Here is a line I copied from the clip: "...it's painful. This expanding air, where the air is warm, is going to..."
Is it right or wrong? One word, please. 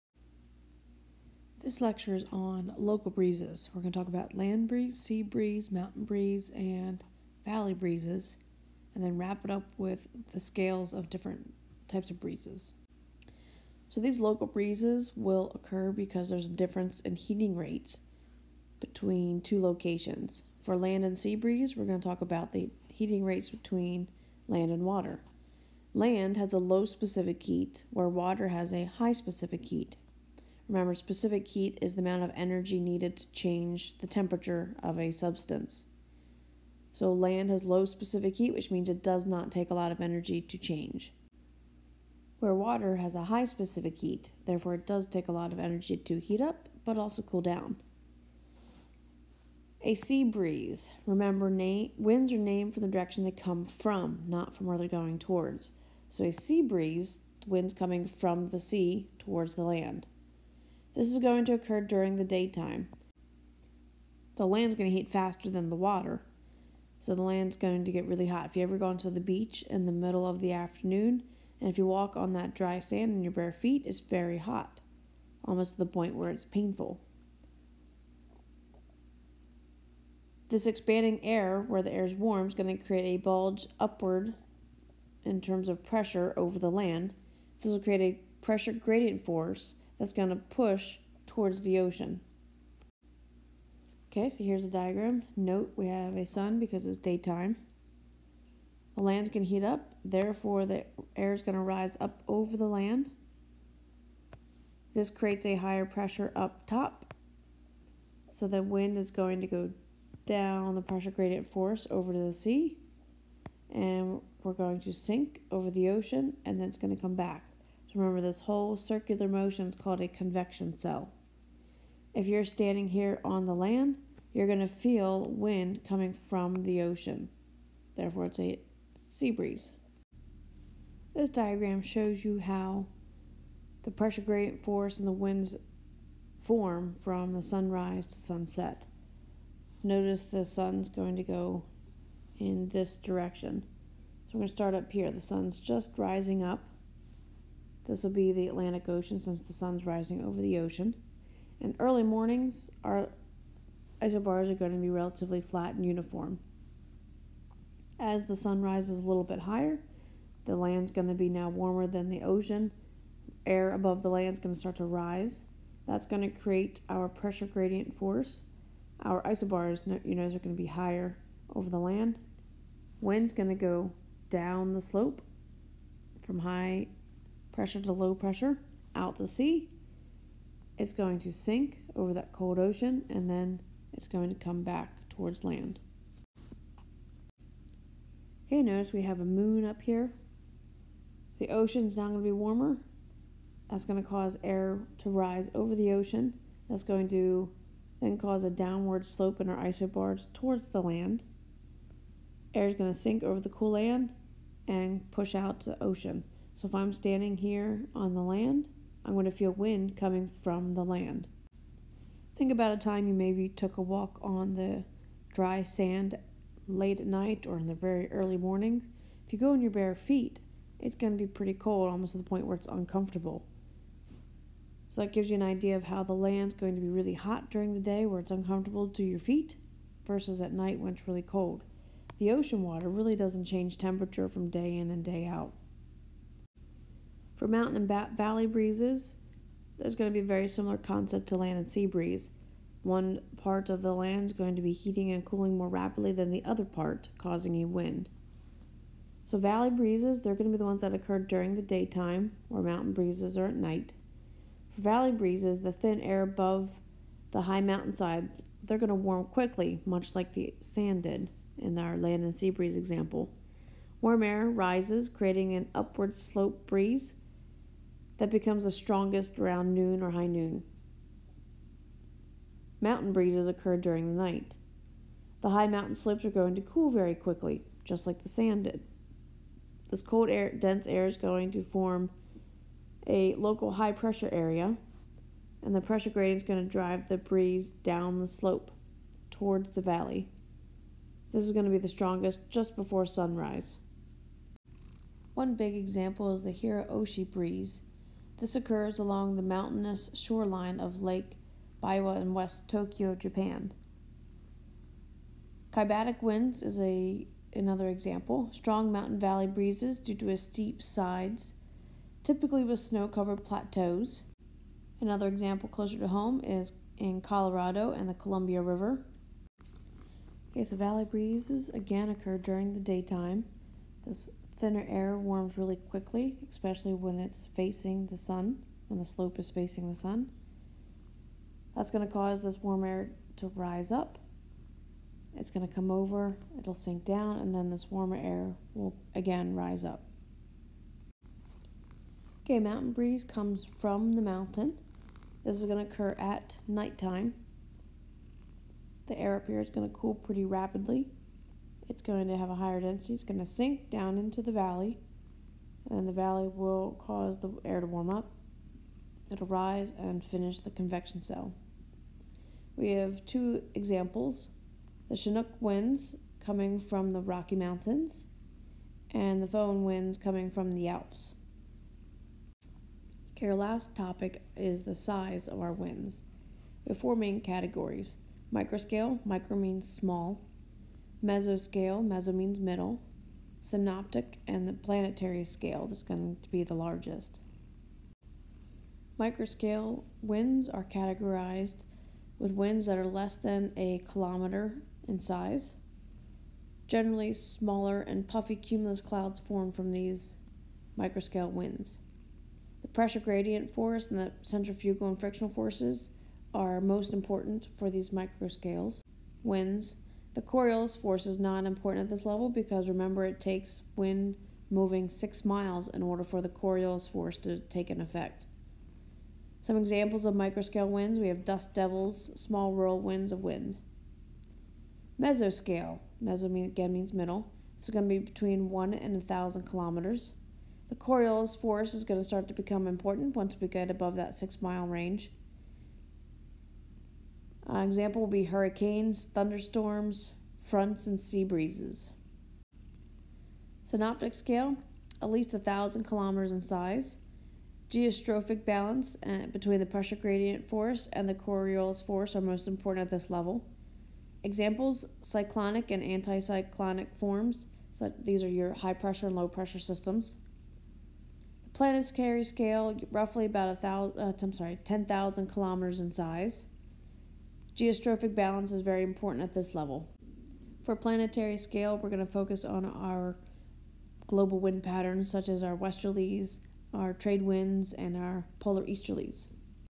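right.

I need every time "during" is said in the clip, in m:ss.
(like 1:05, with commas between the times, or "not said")
1:01, 3:47, 4:11, 4:33, 5:22.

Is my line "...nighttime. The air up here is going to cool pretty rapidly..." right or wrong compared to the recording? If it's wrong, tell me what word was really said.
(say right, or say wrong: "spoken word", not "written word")
right.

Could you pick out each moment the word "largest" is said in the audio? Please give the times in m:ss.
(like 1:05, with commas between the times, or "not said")
6:26.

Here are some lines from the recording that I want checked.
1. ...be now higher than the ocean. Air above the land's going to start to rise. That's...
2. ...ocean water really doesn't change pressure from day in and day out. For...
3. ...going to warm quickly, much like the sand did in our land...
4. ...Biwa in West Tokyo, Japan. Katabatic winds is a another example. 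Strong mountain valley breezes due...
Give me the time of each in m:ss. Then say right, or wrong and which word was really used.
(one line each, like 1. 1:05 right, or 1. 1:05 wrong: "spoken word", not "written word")
1. 2:41 wrong: "warmer", not "higher"
2. 3:52 wrong: "temperature", not "pressure"
3. 4:18 right
4. 5:01 right.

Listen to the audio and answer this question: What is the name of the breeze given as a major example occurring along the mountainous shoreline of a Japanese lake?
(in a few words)
Hira-oroshi.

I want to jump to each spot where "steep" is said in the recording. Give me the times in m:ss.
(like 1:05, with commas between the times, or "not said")
5:10.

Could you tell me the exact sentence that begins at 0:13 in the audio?
So these local breezes will occur because there's a difference in heating rates between two locations.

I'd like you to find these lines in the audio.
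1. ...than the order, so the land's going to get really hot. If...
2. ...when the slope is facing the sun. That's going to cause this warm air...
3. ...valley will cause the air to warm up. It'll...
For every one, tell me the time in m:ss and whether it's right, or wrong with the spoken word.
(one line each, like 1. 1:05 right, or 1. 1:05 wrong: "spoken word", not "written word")
1. 1:05 wrong: "water", not "order"
2. 5:28 right
3. 5:56 right.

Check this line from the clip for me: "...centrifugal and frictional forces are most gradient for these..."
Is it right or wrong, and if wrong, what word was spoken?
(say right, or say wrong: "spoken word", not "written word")
wrong: "important", not "gradient".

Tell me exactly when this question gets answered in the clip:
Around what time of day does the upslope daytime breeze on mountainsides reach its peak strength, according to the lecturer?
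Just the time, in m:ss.
4:30.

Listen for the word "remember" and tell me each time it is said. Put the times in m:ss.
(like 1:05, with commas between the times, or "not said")
0:30, 0:51, 1:57, 6:52.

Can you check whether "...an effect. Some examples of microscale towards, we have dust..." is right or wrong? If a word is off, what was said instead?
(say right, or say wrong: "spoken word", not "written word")
wrong: "winds", not "towards".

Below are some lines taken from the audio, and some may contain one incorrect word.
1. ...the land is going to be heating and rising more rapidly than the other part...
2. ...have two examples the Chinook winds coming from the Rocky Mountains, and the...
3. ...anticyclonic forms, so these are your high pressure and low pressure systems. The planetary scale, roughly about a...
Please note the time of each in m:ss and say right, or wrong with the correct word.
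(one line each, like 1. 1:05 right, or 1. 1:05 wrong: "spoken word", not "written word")
1. 4:03 wrong: "cooling", not "rising"
2. 6:02 right
3. 7:36 right.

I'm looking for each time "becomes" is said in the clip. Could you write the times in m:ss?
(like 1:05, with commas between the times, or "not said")
4:28, 7:12.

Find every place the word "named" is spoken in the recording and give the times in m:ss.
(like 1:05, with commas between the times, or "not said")
0:52.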